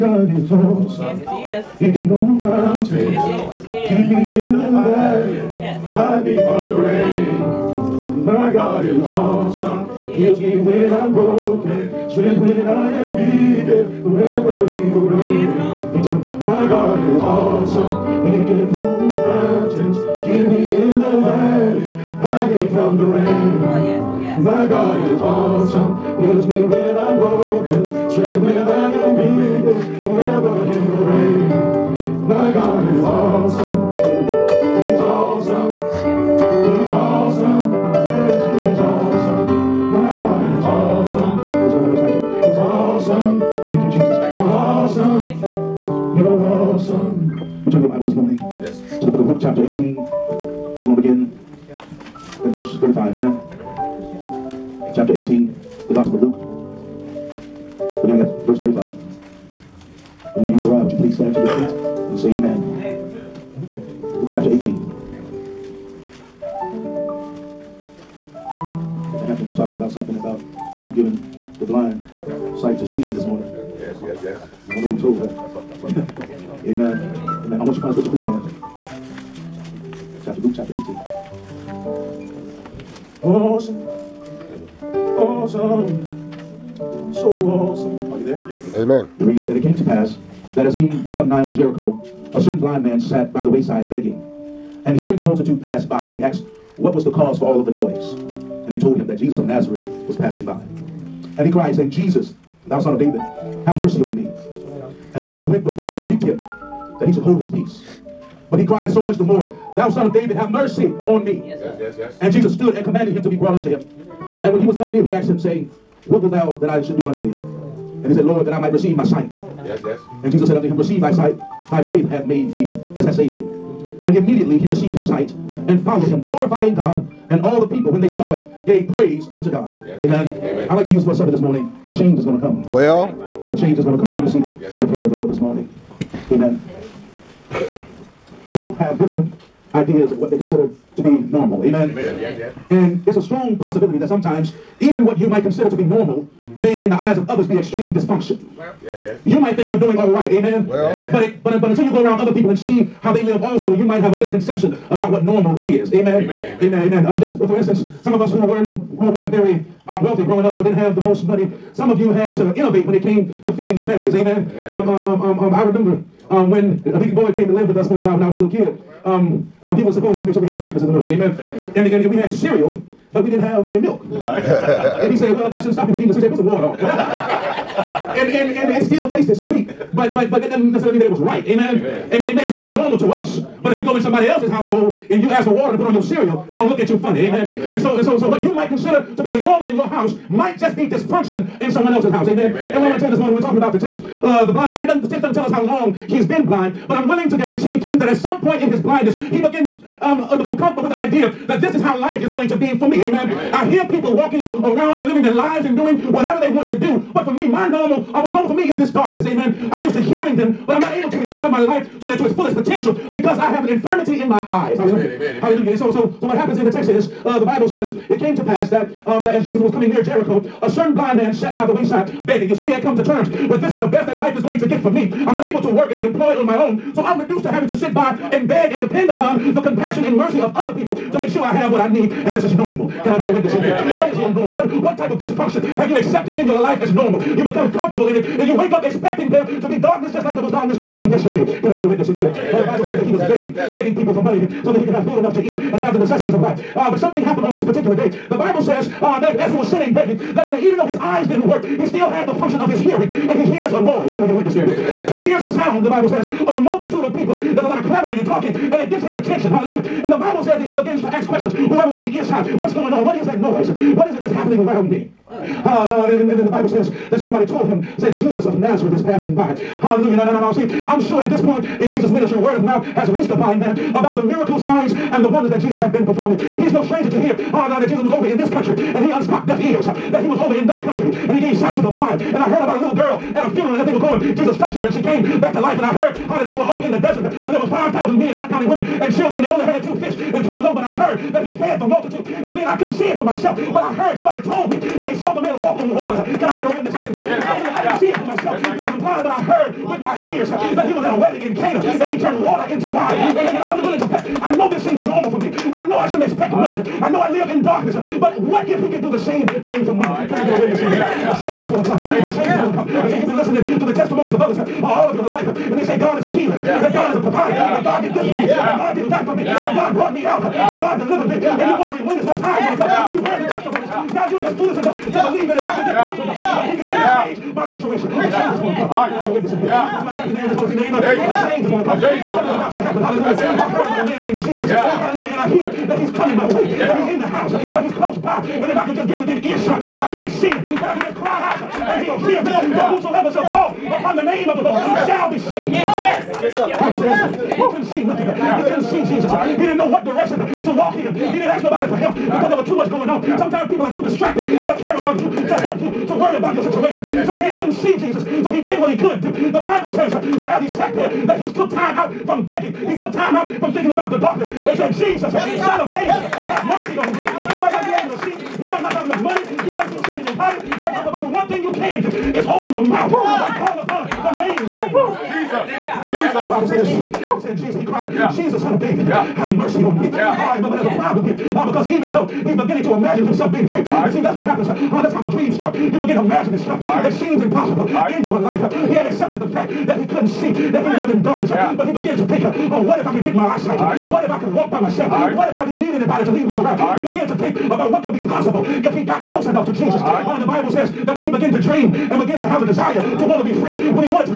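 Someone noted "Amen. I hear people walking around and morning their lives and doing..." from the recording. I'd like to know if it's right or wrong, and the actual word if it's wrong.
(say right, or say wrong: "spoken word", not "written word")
wrong: "living", not "morning".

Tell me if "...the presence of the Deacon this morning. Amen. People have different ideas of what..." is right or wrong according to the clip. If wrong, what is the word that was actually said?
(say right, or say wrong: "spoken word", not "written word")
wrong: "Lord", not "Deacon".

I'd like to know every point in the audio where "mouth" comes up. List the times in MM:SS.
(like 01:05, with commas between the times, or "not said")
04:32, 06:12.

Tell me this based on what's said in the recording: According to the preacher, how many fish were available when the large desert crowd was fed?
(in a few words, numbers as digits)
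2.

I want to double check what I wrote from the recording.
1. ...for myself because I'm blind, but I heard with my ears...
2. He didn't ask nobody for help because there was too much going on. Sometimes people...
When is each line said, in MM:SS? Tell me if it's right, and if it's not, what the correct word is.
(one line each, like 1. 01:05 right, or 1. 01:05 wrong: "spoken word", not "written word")
1. 04:58 right
2. 05:51 right.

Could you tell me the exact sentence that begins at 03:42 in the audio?
You see, he had come to terms but this is the best that life is going to get for me.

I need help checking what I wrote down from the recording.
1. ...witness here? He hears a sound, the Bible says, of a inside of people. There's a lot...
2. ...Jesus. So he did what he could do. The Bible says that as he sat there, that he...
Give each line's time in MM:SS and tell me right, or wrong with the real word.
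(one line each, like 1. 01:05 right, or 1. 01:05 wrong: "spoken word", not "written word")
1. 04:14 wrong: "multitude", not "inside"
2. 05:57 right.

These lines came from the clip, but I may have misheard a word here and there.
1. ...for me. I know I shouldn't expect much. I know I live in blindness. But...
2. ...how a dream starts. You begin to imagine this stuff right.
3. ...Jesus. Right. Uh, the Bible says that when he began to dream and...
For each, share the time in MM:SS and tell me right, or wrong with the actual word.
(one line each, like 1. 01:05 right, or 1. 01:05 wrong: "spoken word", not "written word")
1. 05:05 wrong: "darkness", not "blindness"
2. 06:25 right
3. 06:39 right.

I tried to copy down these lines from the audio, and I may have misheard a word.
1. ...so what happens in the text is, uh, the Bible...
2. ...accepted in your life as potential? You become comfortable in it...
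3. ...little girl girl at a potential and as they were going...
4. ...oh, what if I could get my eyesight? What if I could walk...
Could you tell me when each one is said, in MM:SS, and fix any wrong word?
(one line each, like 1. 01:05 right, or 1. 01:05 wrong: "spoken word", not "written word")
1. 03:36 right
2. 03:55 wrong: "normal", not "potential"
3. 04:42 wrong: "funeral", not "potential"
4. 06:32 right.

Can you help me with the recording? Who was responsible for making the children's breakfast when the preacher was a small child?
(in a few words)
Deacon Boyd.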